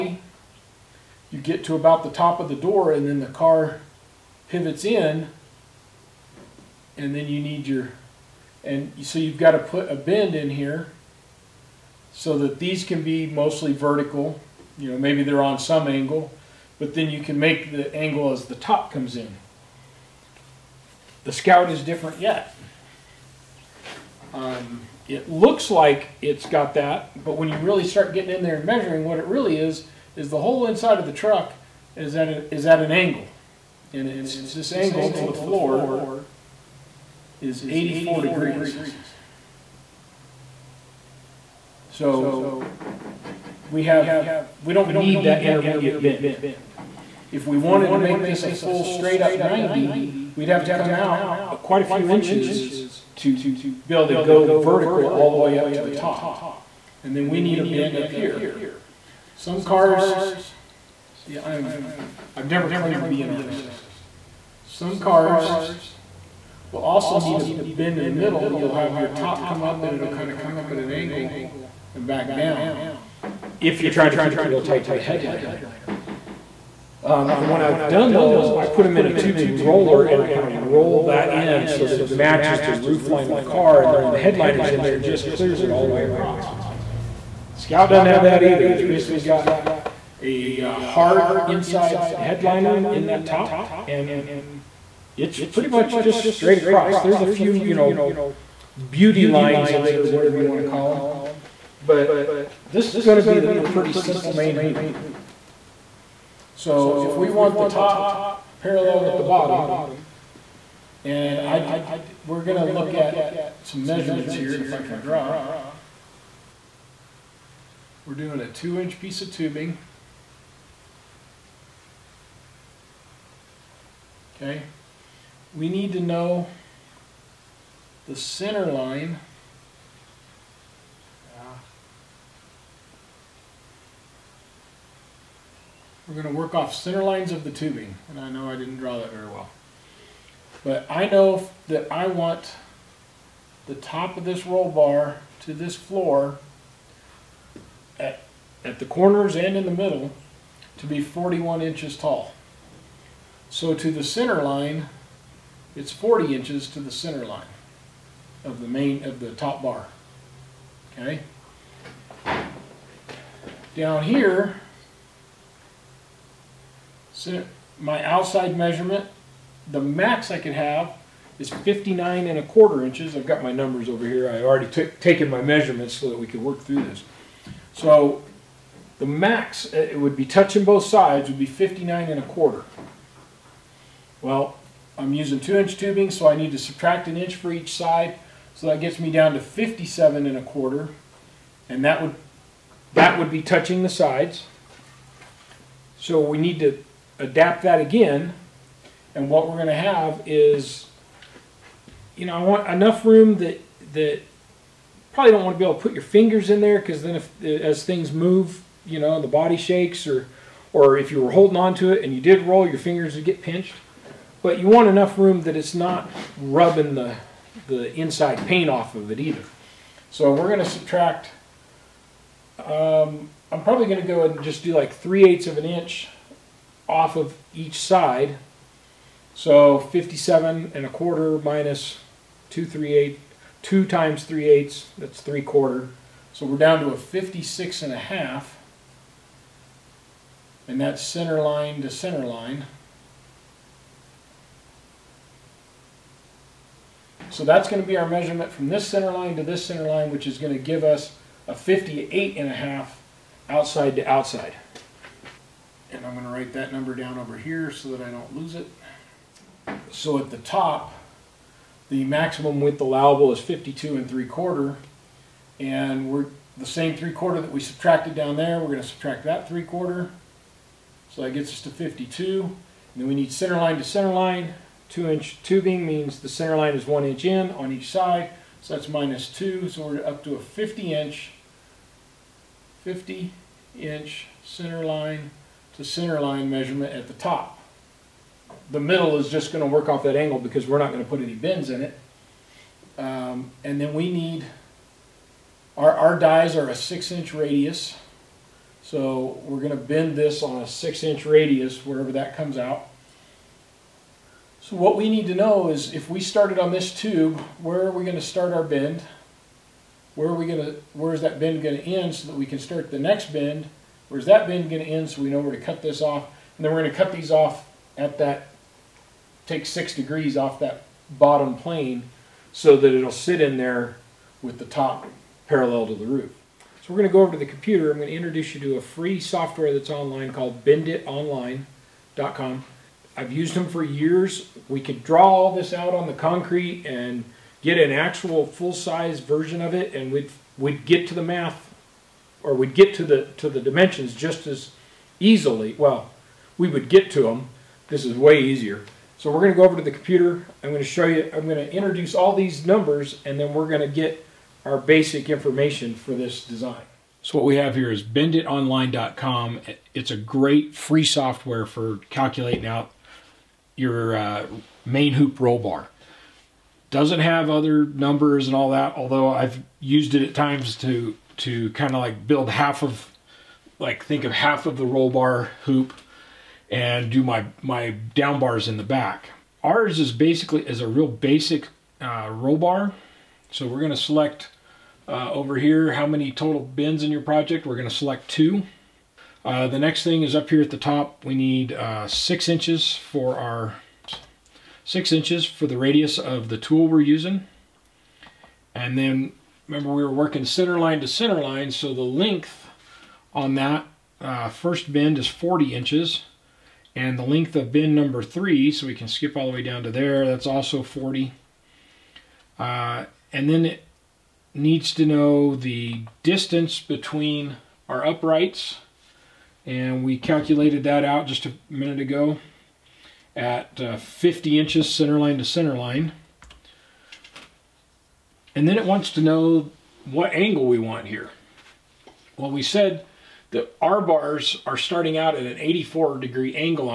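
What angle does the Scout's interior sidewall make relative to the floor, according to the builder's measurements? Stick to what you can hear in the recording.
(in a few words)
84 degrees.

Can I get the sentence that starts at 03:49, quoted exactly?
So 57 and a quarter minus 2 3 8, 2 times 3 eighths, that's 3 quarter.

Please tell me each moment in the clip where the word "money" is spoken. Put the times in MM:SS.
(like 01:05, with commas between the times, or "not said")
not said.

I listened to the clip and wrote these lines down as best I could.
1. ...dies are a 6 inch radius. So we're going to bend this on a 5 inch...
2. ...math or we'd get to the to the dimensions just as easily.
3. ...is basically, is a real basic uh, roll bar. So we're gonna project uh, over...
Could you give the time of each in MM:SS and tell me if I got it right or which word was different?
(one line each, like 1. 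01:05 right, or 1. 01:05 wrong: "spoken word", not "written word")
1. 04:56 wrong: "6", not "5"
2. 05:41 right
3. 06:19 wrong: "select", not "project".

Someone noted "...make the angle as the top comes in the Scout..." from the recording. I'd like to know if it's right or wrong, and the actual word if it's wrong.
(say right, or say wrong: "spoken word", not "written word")
right.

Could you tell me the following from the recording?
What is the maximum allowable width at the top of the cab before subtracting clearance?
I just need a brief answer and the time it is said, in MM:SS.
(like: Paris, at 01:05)
52 3/4 inches, at 04:23.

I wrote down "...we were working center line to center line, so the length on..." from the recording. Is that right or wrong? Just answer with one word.
right.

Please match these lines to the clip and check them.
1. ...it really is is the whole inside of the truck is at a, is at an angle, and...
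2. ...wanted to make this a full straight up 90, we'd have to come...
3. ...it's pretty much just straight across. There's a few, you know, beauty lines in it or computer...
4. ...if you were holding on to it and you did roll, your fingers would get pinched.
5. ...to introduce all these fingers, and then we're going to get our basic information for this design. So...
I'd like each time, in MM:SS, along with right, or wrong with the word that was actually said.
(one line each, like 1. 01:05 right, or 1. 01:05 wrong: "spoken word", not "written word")
1. 00:29 right
2. 00:47 right
3. 01:35 wrong: "whatever", not "computer"
4. 03:30 right
5. 05:51 wrong: "numbers", not "fingers".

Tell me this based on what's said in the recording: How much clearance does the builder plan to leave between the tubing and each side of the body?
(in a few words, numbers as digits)
3/8 inch.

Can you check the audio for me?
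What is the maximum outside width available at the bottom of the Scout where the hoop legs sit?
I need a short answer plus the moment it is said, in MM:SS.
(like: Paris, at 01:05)
59 1/4 inches, at 02:51.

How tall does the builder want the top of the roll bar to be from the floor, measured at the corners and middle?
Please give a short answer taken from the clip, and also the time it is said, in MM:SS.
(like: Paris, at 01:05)
41 inches, at 02:31.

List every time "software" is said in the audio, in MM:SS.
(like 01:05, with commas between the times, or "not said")
05:29, 06:01.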